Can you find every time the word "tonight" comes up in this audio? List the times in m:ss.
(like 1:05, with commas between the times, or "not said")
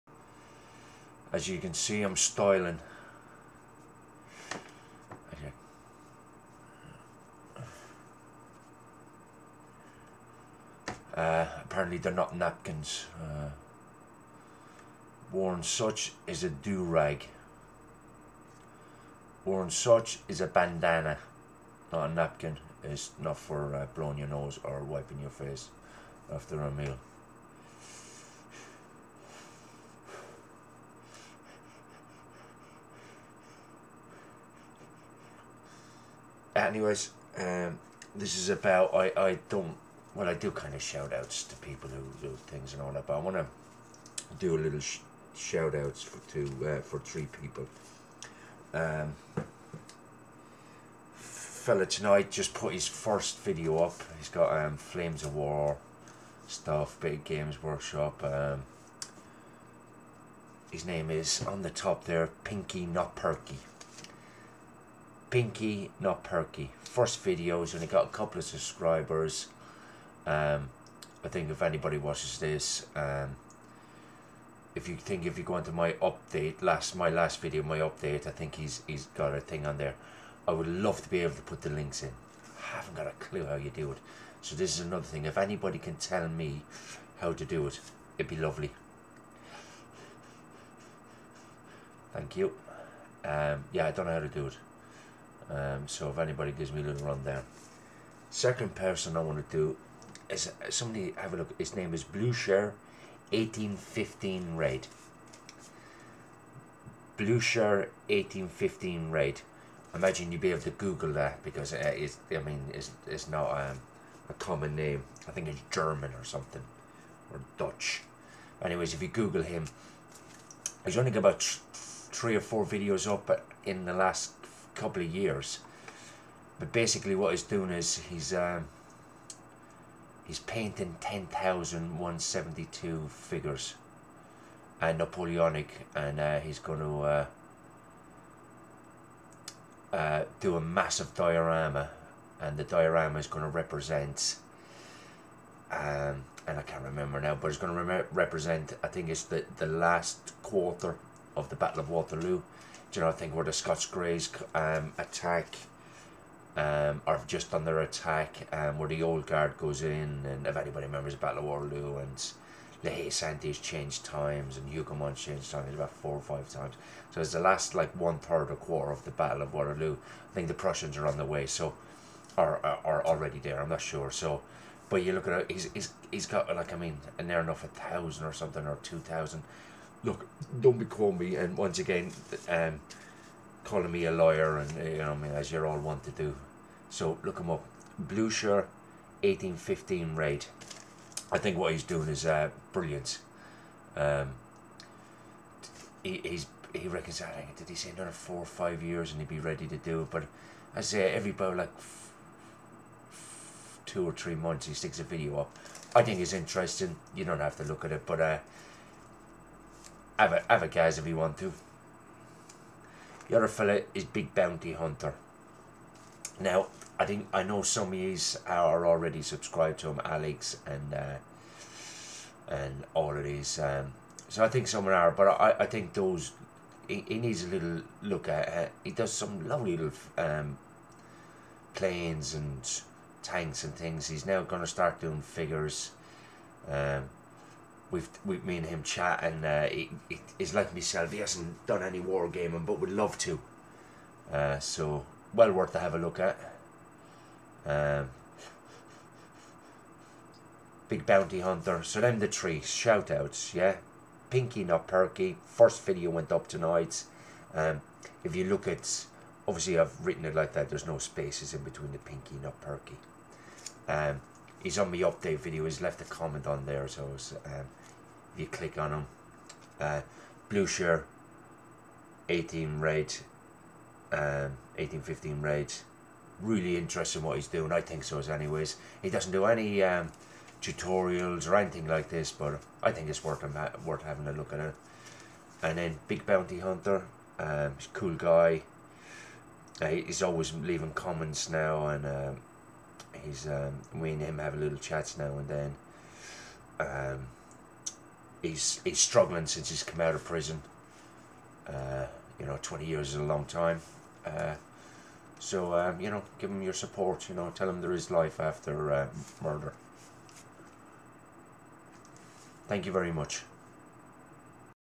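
0:51, 4:16.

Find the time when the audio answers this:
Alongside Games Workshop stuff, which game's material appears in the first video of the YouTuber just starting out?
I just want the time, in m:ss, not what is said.
0:54.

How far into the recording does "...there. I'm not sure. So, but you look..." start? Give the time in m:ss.
2:53.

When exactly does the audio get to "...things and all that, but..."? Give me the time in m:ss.
0:42.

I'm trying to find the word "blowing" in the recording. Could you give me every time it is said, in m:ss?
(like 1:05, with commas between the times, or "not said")
0:23.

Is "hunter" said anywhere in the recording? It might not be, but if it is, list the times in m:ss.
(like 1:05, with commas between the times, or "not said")
3:34, 4:11, 4:46.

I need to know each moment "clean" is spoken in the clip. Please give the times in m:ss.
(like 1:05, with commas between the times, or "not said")
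not said.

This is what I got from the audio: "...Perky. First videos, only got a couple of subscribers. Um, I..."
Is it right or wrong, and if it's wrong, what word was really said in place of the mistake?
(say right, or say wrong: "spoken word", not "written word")
right.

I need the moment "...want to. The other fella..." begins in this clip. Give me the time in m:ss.
3:31.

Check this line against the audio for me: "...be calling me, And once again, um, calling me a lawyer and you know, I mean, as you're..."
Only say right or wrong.
right.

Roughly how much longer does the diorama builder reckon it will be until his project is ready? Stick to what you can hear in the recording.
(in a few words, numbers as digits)
4 or 5 years.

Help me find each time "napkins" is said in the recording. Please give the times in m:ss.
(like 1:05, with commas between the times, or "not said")
0:12, 0:22.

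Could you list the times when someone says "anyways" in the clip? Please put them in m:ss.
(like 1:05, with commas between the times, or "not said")
0:36, 1:58, 4:38.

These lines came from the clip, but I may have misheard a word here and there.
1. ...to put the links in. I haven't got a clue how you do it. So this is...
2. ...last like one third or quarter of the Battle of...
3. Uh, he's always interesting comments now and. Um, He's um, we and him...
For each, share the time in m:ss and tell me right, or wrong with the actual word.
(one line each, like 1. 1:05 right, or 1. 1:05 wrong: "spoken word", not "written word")
1. 1:21 right
2. 2:47 right
3. 4:49 wrong: "leaving", not "interesting".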